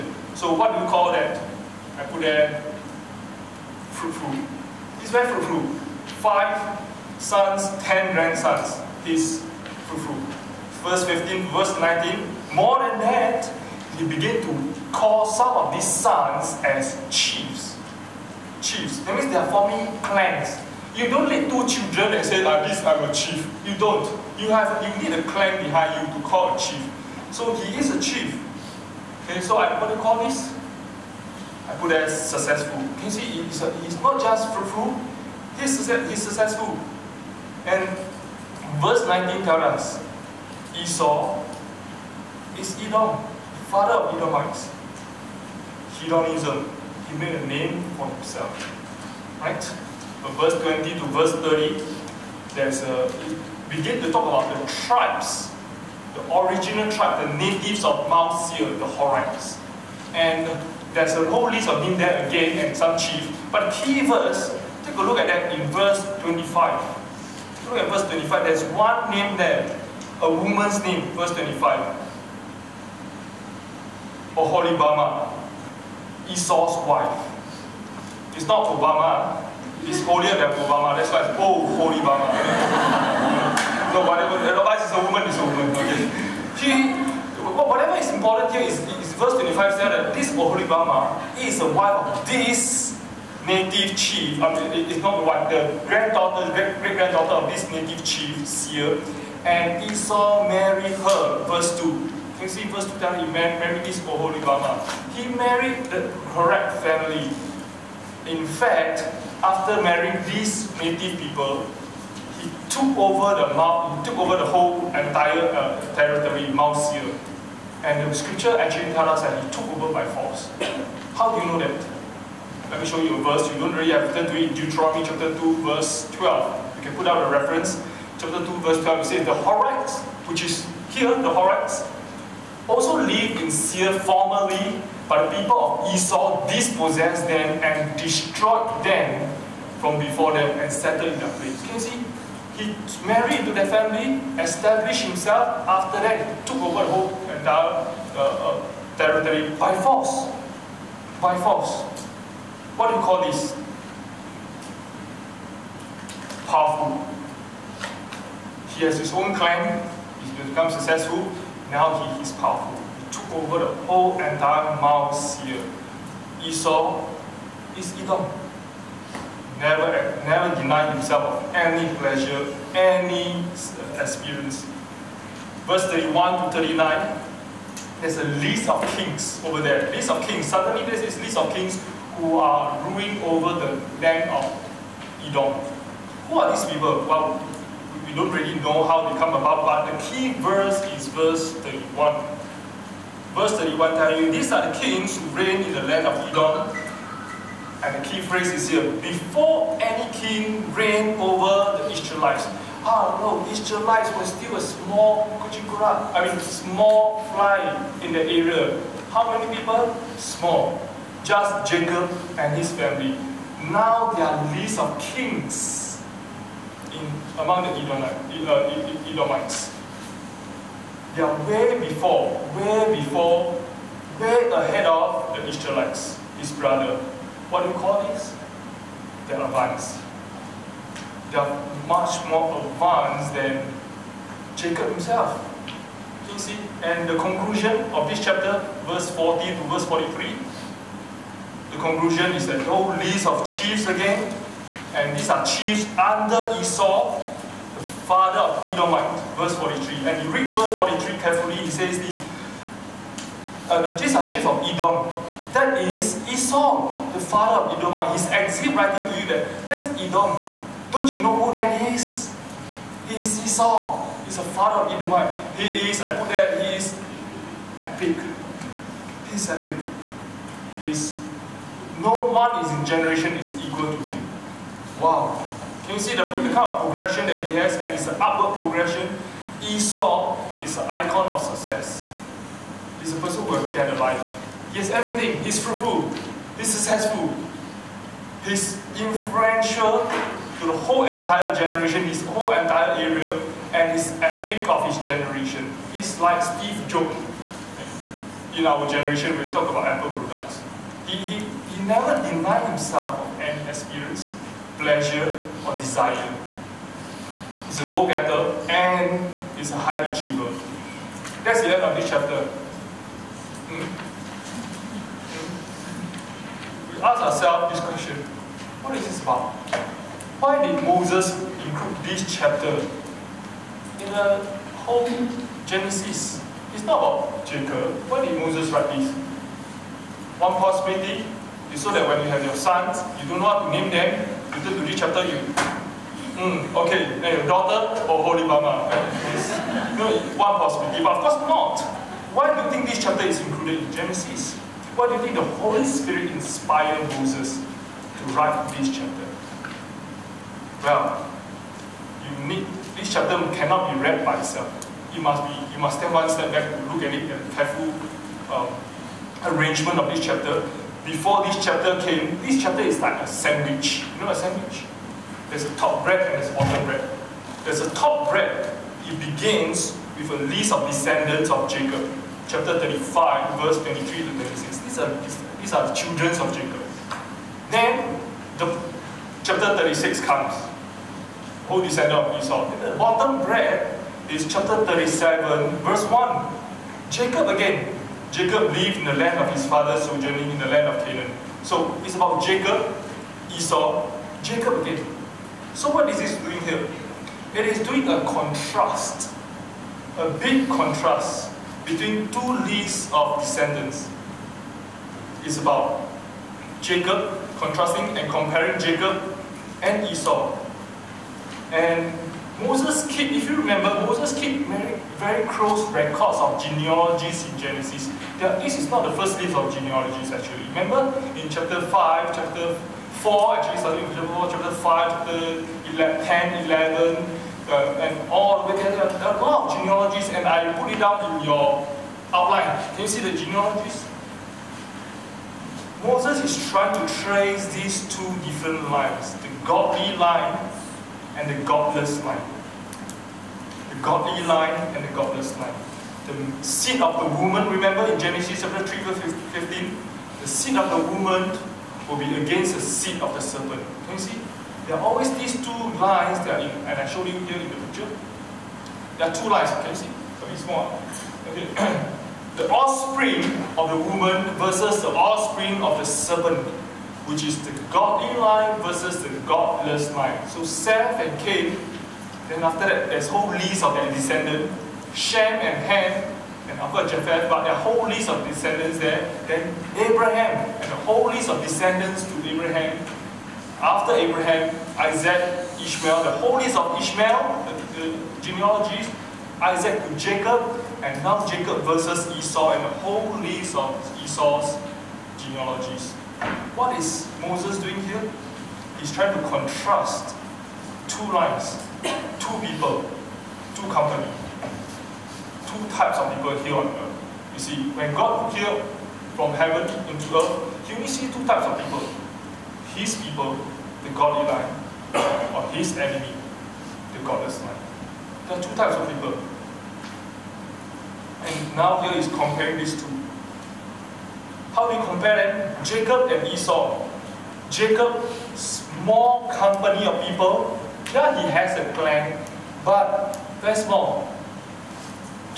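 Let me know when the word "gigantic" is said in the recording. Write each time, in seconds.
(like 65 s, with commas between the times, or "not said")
not said.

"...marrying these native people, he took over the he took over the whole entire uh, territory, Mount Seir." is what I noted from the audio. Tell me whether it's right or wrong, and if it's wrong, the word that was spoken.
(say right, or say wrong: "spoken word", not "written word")
right.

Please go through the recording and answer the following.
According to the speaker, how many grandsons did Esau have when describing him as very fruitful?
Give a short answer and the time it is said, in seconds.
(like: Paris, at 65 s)
10, at 7 s.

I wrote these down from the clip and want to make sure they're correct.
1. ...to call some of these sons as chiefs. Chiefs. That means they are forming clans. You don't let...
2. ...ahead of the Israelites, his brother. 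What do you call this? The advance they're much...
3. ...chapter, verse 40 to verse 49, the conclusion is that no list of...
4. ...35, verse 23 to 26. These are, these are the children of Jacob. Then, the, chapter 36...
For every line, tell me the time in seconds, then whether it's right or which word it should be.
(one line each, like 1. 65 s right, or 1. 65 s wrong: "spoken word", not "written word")
1. 14 s right
2. 224 s right
3. 238 s wrong: "43", not "49"
4. 372 s right.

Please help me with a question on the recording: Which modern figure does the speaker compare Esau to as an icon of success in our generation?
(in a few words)
Steve Jobs.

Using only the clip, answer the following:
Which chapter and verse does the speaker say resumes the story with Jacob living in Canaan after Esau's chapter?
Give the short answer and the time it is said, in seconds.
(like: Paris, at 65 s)
Chapter 37, verse 1, at 384 s.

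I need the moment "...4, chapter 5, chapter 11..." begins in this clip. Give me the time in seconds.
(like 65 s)
424 s.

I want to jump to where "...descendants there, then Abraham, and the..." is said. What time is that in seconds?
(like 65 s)
478 s.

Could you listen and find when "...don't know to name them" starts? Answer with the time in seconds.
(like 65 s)
333 s.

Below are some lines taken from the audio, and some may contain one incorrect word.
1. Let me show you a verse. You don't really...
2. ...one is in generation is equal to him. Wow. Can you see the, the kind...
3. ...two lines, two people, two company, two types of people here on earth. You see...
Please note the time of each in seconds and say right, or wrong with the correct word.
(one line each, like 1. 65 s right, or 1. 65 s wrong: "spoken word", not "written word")
1. 122 s right
2. 272 s right
3. 501 s right.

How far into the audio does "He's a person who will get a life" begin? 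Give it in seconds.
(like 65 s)
282 s.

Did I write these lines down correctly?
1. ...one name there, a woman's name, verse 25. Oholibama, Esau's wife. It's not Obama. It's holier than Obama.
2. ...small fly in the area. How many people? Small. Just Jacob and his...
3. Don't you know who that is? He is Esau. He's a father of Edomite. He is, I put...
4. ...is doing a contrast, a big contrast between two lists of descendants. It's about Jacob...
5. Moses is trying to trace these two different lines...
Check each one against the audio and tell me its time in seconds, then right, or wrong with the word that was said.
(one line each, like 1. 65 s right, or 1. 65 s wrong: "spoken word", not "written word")
1. 68 s right
2. 206 s right
3. 260 s right
4. 397 s right
5. 436 s right.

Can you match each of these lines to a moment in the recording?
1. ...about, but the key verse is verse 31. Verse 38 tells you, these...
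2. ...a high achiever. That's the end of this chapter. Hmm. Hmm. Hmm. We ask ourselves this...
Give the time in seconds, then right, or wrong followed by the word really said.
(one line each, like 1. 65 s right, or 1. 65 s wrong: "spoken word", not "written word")
1. 189 s wrong: "31", not "38"
2. 309 s right.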